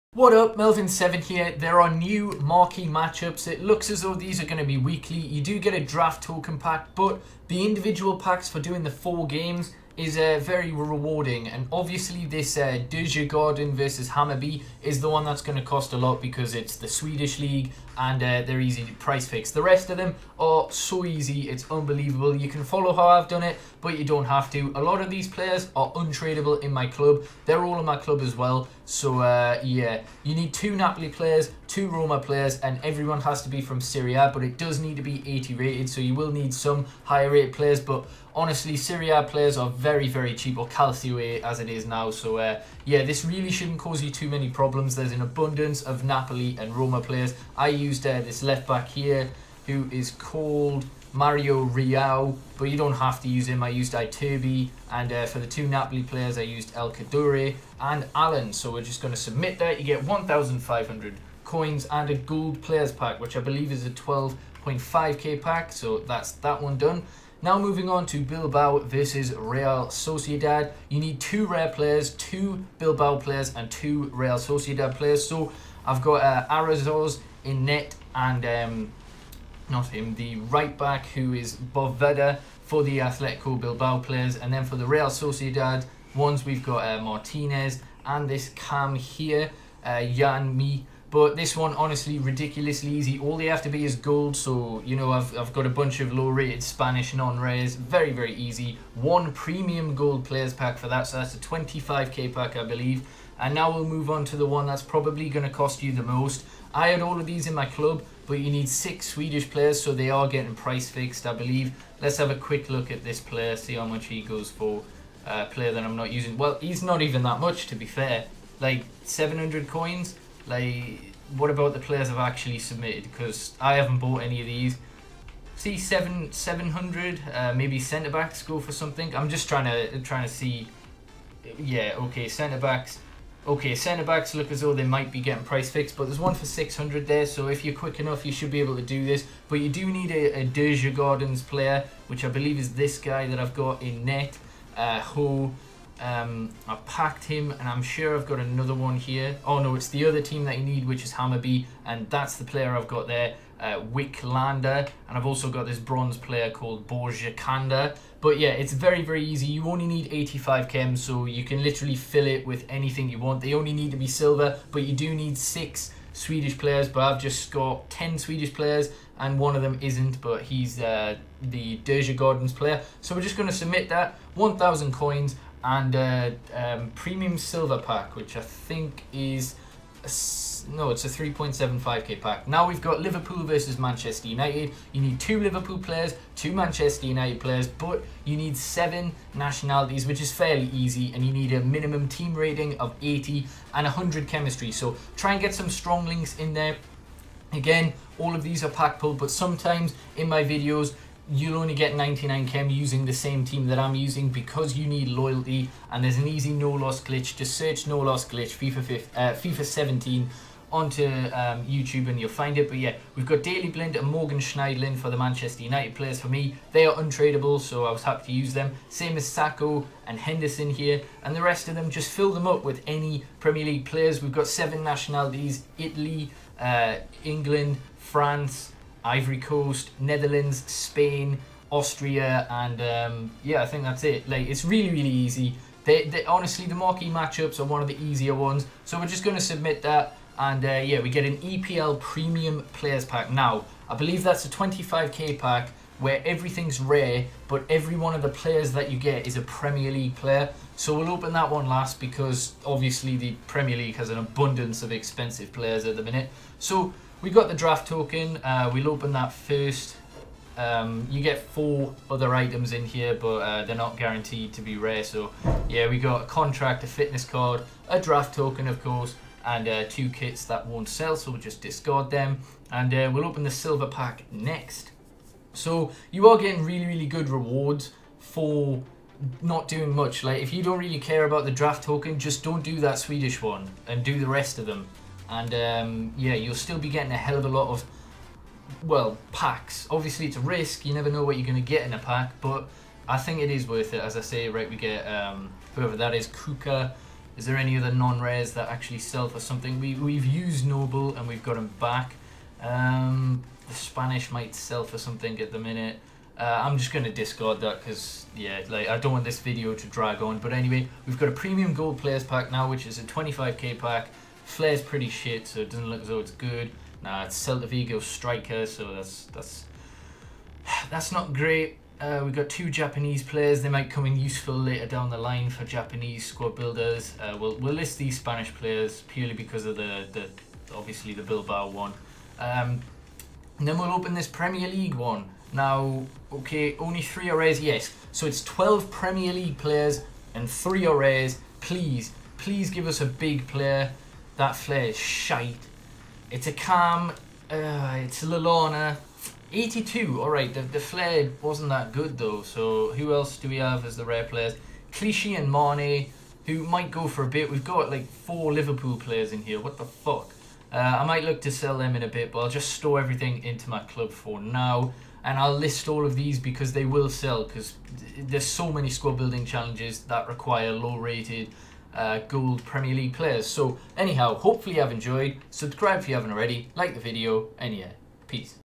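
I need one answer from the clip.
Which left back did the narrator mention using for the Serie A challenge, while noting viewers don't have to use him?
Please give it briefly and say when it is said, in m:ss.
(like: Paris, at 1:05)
Mario Rui, at 0:51.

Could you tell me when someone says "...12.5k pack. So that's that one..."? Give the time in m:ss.
1:03.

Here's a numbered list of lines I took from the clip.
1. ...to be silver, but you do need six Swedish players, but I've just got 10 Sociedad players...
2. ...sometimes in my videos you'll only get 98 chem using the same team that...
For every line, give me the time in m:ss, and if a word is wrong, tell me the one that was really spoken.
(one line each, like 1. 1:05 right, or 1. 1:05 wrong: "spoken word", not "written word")
1. 2:43 wrong: "Swedish", not "Sociedad"
2. 3:19 wrong: "99", not "98".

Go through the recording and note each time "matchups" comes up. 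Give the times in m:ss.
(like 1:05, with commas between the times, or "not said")
0:02, 3:57.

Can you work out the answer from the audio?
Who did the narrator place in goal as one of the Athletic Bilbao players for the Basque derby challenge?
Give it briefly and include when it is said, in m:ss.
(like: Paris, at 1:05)
Iraizoz, at 1:16.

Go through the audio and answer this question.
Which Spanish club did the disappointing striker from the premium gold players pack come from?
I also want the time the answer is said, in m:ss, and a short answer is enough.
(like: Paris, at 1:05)
Celta Vigo, at 5:17.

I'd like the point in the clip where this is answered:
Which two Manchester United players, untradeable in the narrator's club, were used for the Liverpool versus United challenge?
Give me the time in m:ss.
3:33.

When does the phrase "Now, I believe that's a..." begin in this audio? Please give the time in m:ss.
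4:03.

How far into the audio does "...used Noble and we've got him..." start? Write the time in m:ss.
5:00.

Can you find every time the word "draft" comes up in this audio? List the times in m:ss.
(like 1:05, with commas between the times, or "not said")
0:05, 4:17, 4:27, 4:41.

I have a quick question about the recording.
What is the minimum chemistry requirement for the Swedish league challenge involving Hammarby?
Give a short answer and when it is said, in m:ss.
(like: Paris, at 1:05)
85, at 2:40.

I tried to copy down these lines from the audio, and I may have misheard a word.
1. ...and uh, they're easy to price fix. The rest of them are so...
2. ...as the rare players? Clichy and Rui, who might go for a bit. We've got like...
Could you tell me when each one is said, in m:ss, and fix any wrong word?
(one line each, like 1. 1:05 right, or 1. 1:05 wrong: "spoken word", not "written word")
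1. 0:17 right
2. 5:53 wrong: "Mane", not "Rui".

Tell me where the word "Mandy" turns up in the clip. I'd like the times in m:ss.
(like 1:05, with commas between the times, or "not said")
not said.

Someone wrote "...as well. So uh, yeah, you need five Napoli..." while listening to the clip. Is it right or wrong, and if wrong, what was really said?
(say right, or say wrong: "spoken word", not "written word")
wrong: "two", not "five".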